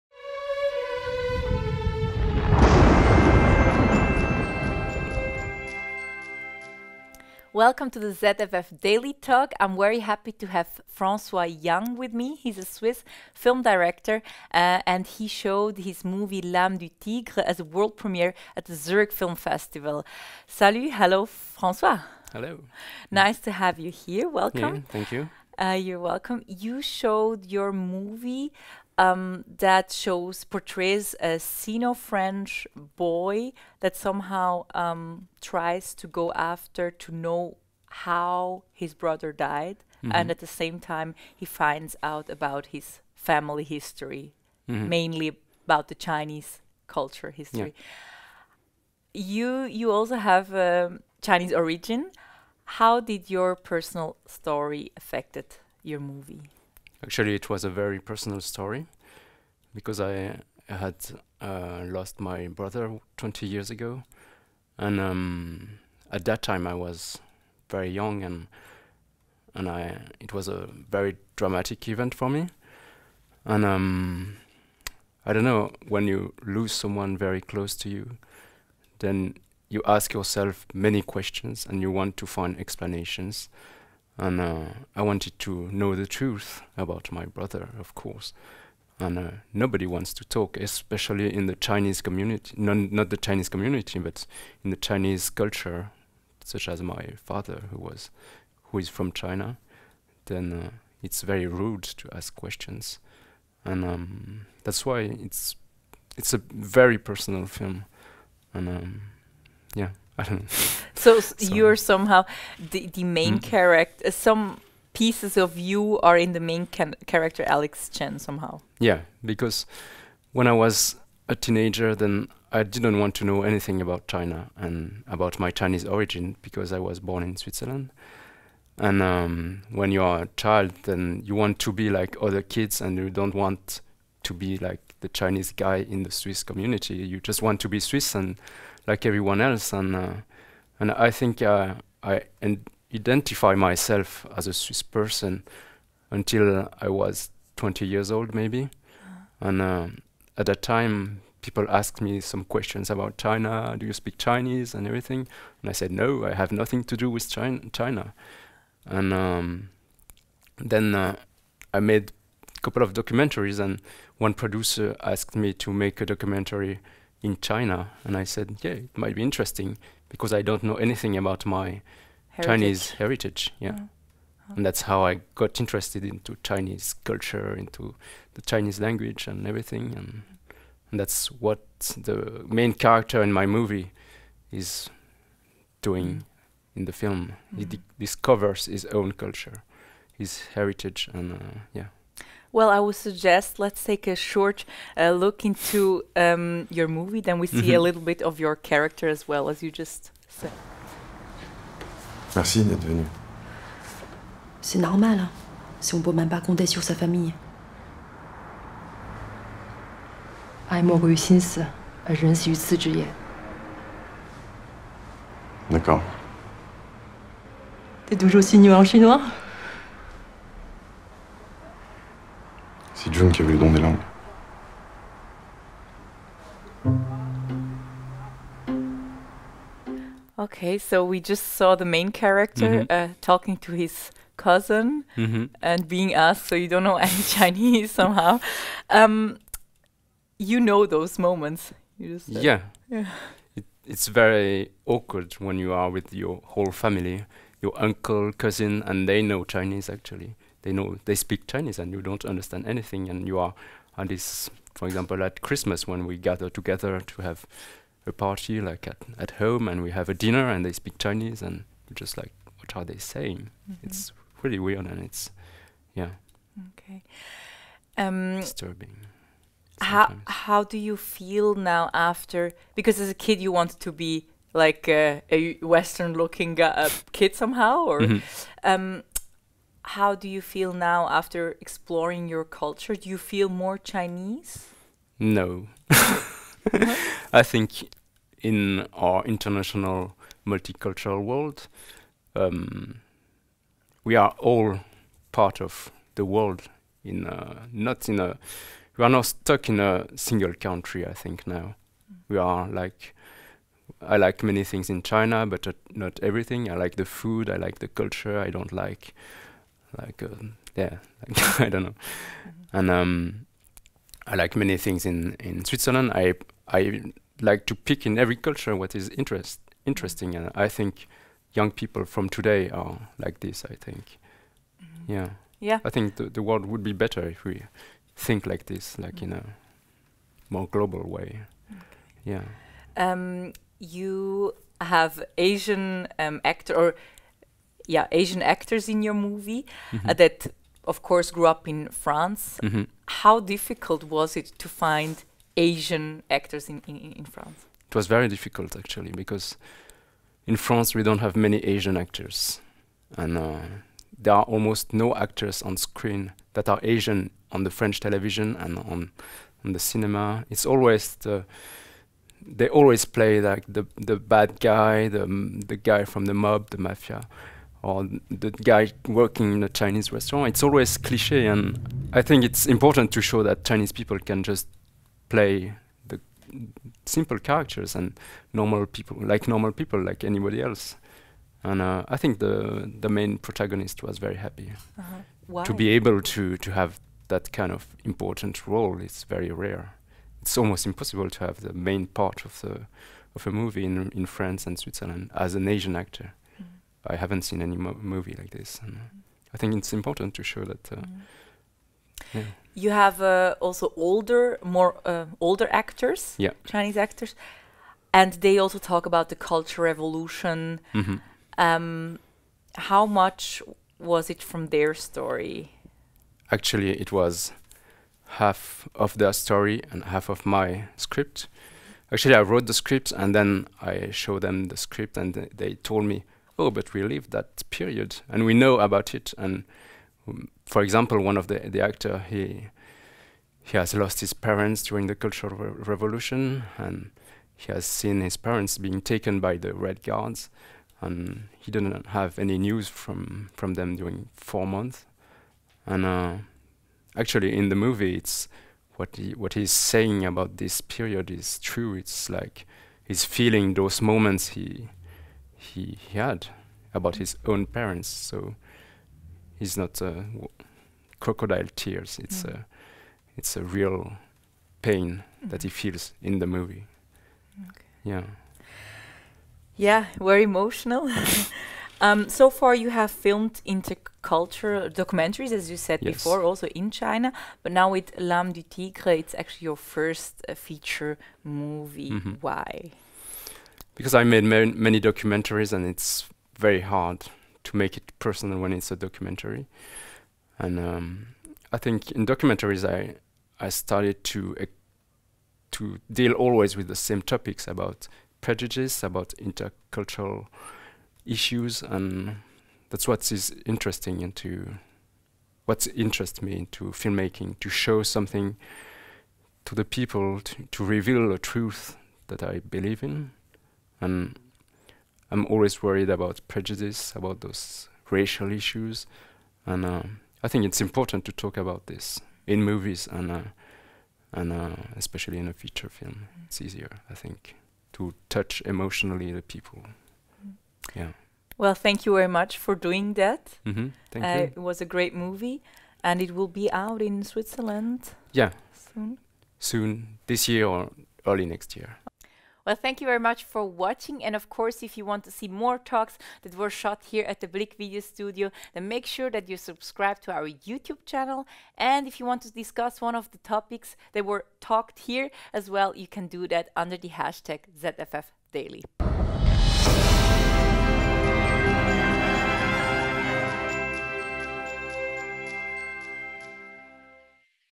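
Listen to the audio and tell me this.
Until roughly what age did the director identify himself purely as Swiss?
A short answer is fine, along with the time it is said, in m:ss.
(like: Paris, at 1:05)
20, at 2:27.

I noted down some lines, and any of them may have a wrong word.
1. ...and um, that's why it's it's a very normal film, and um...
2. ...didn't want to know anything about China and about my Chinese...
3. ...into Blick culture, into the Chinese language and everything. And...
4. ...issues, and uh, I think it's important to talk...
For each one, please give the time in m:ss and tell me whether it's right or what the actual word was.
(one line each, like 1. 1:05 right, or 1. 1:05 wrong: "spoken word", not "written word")
1. 1:43 wrong: "personal", not "normal"
2. 2:02 right
3. 2:56 wrong: "Chinese", not "Blick"
4. 8:38 right.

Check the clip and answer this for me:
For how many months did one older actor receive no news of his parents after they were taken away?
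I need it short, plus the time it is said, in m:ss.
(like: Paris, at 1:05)
4, at 7:24.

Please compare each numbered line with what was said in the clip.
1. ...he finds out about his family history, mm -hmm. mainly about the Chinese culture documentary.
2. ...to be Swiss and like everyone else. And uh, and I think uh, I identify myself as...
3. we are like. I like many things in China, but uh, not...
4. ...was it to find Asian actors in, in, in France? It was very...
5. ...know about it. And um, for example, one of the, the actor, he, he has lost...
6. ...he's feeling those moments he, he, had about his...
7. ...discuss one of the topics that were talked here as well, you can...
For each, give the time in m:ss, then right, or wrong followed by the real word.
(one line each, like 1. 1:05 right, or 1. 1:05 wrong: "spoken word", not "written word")
1. 0:41 wrong: "history", not "documentary"
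2. 2:17 right
3. 5:02 right
4. 5:44 right
5. 7:08 right
6. 7:33 right
7. 9:12 right.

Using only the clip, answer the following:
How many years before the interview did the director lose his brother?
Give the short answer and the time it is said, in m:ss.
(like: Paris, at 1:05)
20 years, at 1:03.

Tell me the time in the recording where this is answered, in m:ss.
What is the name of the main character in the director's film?
1:57.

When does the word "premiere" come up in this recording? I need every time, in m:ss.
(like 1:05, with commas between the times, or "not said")
0:17.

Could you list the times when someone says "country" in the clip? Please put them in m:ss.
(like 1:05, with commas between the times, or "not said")
5:00.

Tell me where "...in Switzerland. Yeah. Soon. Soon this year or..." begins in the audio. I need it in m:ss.
8:57.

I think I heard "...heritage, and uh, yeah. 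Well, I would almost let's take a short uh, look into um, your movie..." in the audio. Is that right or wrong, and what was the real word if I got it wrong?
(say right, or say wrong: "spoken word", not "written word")
wrong: "suggest", not "almost".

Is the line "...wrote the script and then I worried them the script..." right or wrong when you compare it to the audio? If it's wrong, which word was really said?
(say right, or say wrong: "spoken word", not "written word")
wrong: "showed", not "worried".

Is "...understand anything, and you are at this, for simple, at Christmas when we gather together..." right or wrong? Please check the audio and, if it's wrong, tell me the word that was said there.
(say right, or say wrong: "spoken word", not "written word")
wrong: "example", not "simple".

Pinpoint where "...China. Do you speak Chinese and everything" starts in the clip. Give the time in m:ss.
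2:33.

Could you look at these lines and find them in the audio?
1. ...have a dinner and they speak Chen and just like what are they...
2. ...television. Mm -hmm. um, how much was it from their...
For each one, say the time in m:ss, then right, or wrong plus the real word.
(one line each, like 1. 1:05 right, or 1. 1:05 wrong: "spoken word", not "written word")
1. 4:19 wrong: "Chinese", not "Chen"
2. 6:49 wrong: "revolution", not "television".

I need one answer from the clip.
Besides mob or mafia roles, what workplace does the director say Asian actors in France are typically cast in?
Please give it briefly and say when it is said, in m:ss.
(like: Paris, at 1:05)
Chinese restaurant, at 6:09.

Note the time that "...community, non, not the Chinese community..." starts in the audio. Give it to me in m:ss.
1:32.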